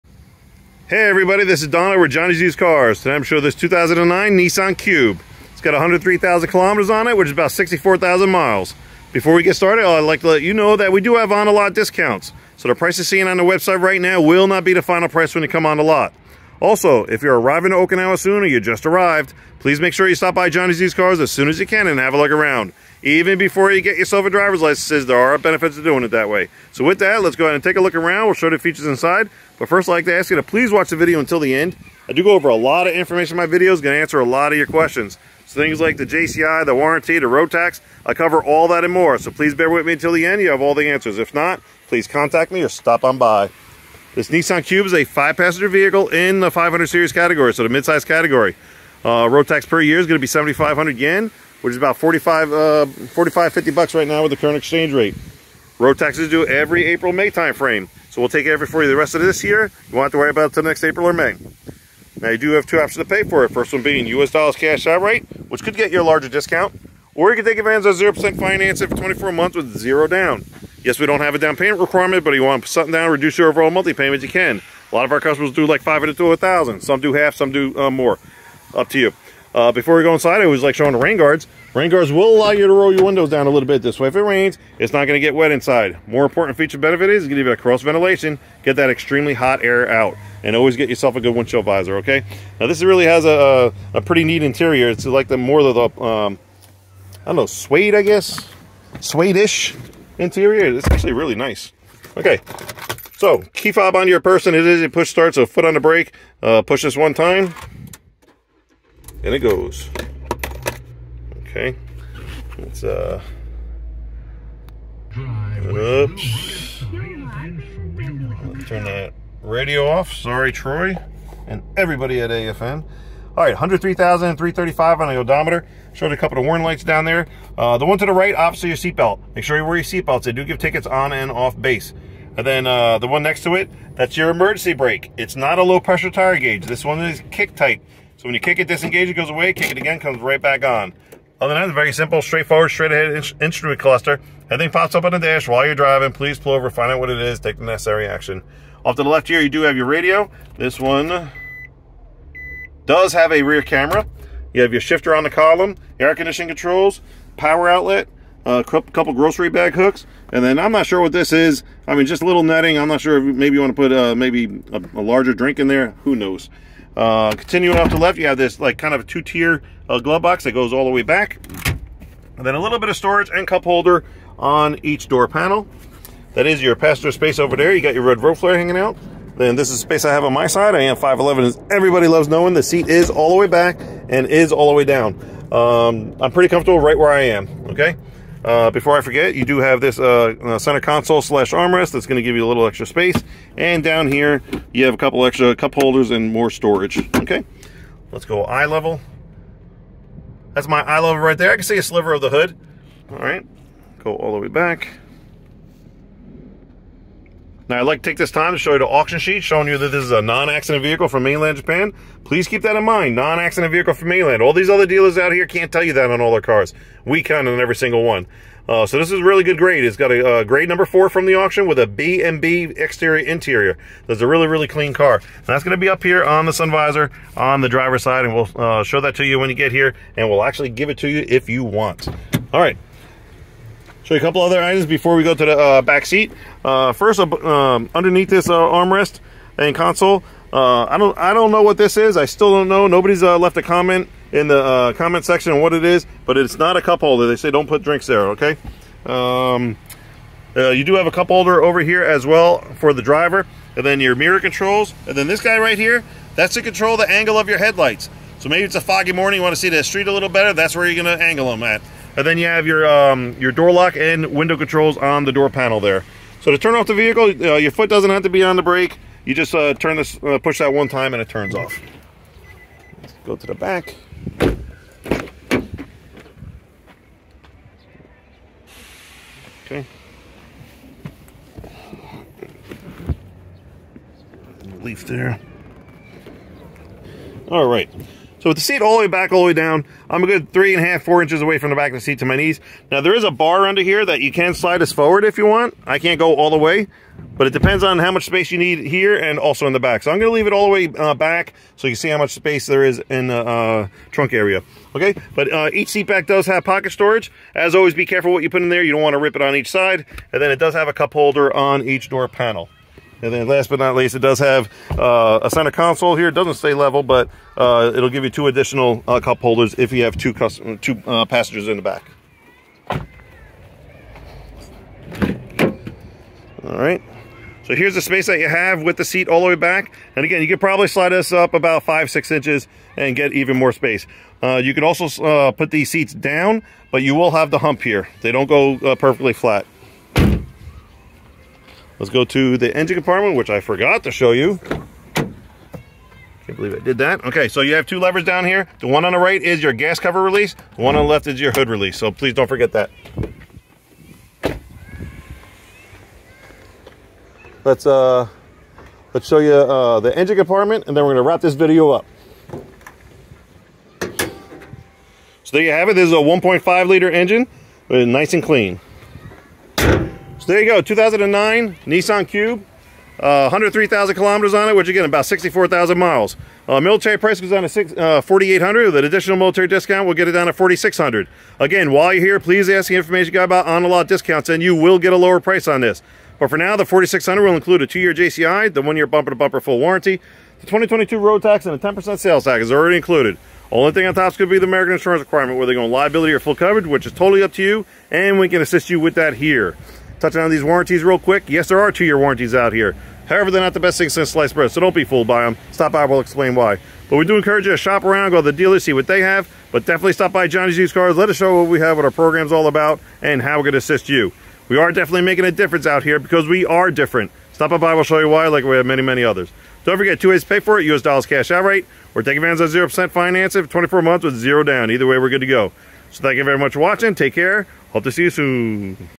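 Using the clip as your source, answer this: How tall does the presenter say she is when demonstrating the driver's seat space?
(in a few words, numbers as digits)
5'11.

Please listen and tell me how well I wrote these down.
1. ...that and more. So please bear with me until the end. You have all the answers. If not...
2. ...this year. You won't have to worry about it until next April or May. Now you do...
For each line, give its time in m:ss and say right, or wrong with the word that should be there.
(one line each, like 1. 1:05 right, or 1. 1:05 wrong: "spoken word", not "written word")
1. 0:38 right
2. 0:59 right.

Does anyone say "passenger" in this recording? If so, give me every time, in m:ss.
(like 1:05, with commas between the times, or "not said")
0:45, 2:56, 5:21.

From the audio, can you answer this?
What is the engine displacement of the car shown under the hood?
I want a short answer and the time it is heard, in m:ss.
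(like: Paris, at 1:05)
1.5 liter, at 6:06.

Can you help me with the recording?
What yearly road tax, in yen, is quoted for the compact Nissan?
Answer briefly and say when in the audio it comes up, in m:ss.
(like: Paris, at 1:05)
7,500 yen, at 0:50.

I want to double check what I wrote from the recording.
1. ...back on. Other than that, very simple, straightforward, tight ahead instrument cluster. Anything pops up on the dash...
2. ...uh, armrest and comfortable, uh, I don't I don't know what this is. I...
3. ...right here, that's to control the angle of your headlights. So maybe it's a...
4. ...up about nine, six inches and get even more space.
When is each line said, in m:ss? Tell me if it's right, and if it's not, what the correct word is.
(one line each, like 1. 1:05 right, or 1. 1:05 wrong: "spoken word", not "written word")
1. 2:20 wrong: "straight", not "tight"
2. 3:58 wrong: "console", not "comfortable"
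3. 4:15 right
4. 5:31 wrong: "five", not "nine".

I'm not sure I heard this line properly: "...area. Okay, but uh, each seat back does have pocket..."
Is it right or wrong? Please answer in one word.
right.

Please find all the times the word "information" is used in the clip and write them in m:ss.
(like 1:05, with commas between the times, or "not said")
0:32, 6:22.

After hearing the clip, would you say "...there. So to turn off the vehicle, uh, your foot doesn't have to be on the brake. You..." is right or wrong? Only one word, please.
right.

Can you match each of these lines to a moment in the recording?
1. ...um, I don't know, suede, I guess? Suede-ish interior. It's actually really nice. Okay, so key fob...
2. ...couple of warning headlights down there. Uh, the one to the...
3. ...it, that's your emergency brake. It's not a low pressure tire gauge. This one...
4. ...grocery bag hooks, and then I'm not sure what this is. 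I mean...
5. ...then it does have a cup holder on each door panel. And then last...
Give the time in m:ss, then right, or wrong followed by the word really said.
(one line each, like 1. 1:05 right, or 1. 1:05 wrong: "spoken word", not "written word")
1. 1:36 right
2. 2:06 wrong: "lights", not "headlights"
3. 2:13 right
4. 2:39 right
5. 5:10 right.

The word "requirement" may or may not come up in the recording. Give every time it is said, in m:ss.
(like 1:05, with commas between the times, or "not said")
1:11, 6:35.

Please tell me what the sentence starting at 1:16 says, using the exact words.
Some do half, some do uh, more.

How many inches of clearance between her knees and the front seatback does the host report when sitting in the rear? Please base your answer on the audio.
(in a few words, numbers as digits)
3.5 to 4 inches.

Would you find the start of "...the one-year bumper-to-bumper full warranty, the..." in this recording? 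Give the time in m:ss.
6:28.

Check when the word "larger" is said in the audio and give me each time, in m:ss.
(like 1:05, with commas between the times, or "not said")
1:06, 2:45.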